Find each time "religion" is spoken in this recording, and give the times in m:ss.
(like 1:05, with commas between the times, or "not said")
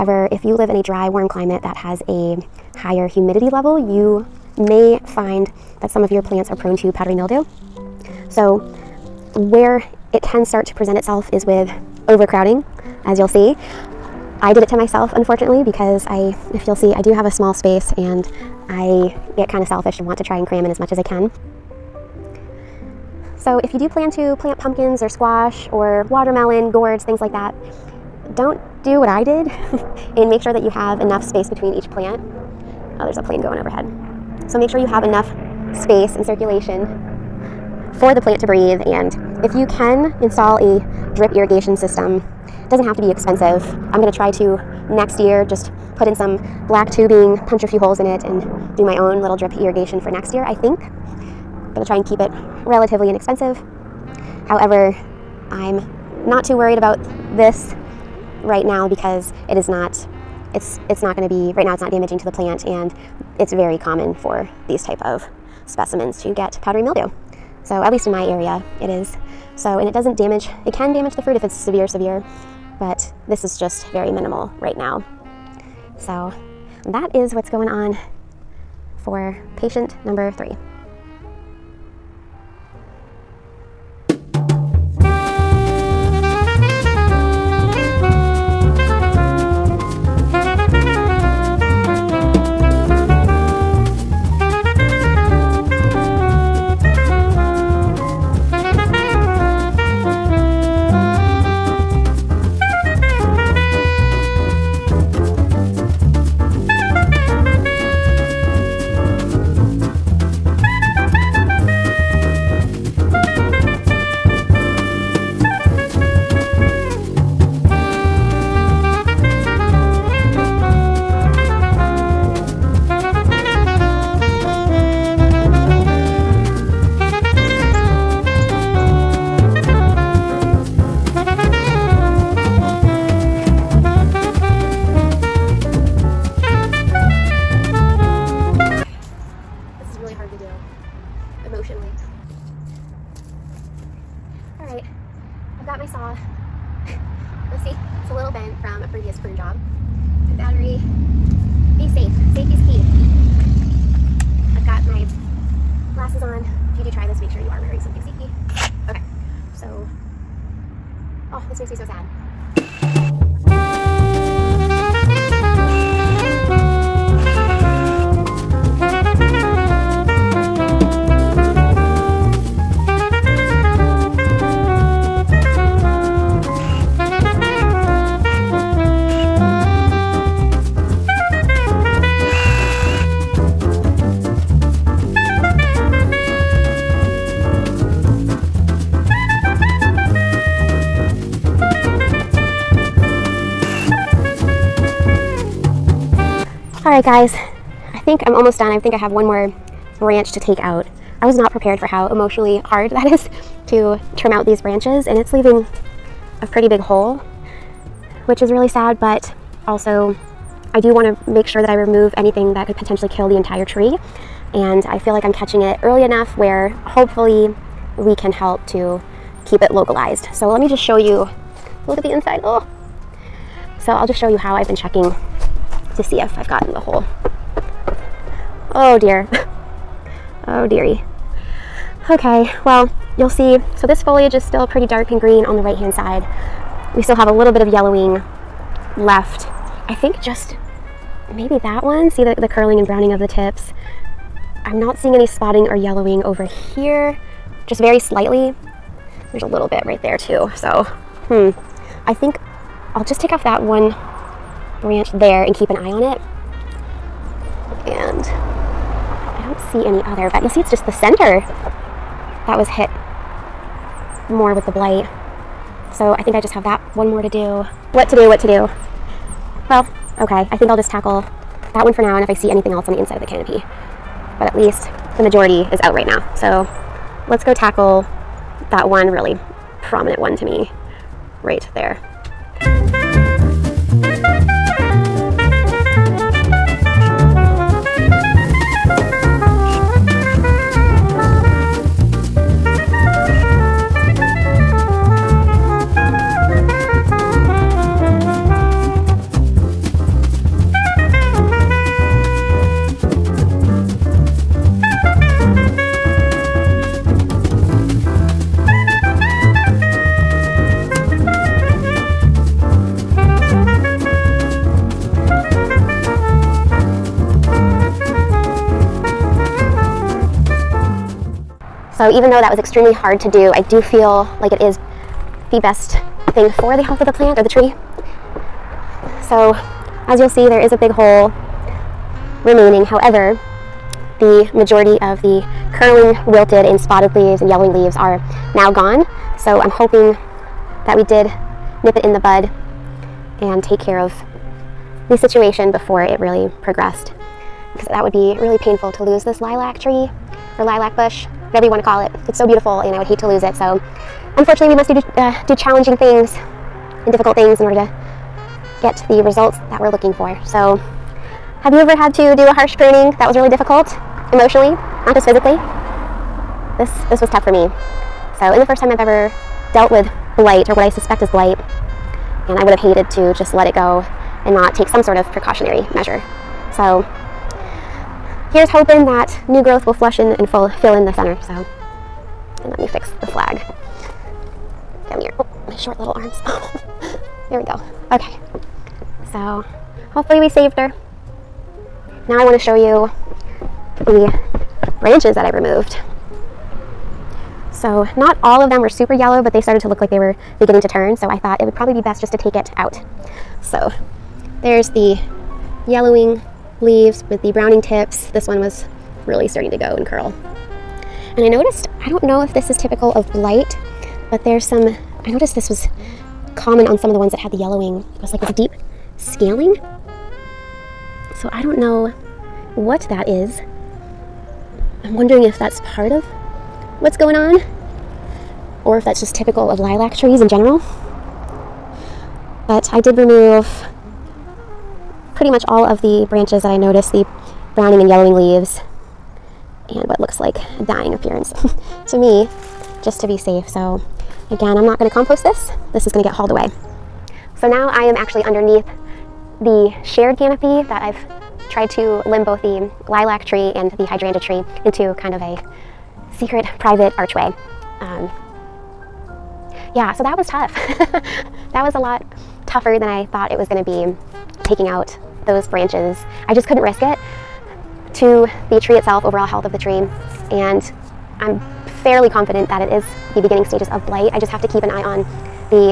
not said.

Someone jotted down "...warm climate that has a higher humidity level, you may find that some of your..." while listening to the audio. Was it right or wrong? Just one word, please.
right.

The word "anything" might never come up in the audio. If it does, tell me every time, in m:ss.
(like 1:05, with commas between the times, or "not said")
3:32, 4:32.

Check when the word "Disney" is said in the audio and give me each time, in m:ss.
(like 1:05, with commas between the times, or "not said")
not said.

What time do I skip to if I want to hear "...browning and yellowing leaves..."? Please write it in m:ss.
7:17.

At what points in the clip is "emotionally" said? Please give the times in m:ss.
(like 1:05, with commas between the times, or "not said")
3:22, 6:04.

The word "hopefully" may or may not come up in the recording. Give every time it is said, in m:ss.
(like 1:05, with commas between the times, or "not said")
3:36, 6:30.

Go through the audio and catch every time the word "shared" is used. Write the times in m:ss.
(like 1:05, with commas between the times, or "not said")
7:30.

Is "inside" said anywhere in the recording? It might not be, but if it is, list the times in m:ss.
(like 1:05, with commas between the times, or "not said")
3:42, 4:32.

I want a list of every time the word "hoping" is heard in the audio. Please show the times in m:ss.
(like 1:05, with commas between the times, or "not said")
5:39, 6:18.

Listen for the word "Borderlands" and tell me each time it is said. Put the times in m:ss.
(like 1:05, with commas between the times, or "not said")
not said.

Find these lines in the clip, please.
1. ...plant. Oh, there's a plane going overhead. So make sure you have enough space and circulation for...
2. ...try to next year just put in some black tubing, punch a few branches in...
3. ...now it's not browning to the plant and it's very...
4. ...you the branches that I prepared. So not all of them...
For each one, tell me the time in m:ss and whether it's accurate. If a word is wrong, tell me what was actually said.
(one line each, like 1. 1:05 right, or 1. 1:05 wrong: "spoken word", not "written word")
1. 0:31 right
2. 0:44 wrong: "holes", not "branches"
3. 1:01 wrong: "damaging", not "browning"
4. 6:32 wrong: "removed", not "prepared".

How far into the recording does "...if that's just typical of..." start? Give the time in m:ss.
7:08.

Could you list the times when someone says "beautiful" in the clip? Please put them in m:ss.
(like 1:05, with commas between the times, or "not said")
5:52.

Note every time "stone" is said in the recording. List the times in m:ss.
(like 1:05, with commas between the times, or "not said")
not said.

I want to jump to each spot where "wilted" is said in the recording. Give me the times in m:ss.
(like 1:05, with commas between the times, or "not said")
5:36.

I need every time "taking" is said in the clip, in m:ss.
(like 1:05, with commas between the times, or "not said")
7:44.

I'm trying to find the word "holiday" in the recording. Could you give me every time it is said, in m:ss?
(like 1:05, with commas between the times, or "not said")
not said.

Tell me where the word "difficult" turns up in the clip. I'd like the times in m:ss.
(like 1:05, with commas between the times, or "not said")
5:57, 6:03.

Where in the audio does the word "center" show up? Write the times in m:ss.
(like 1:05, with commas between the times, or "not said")
4:20, 6:21.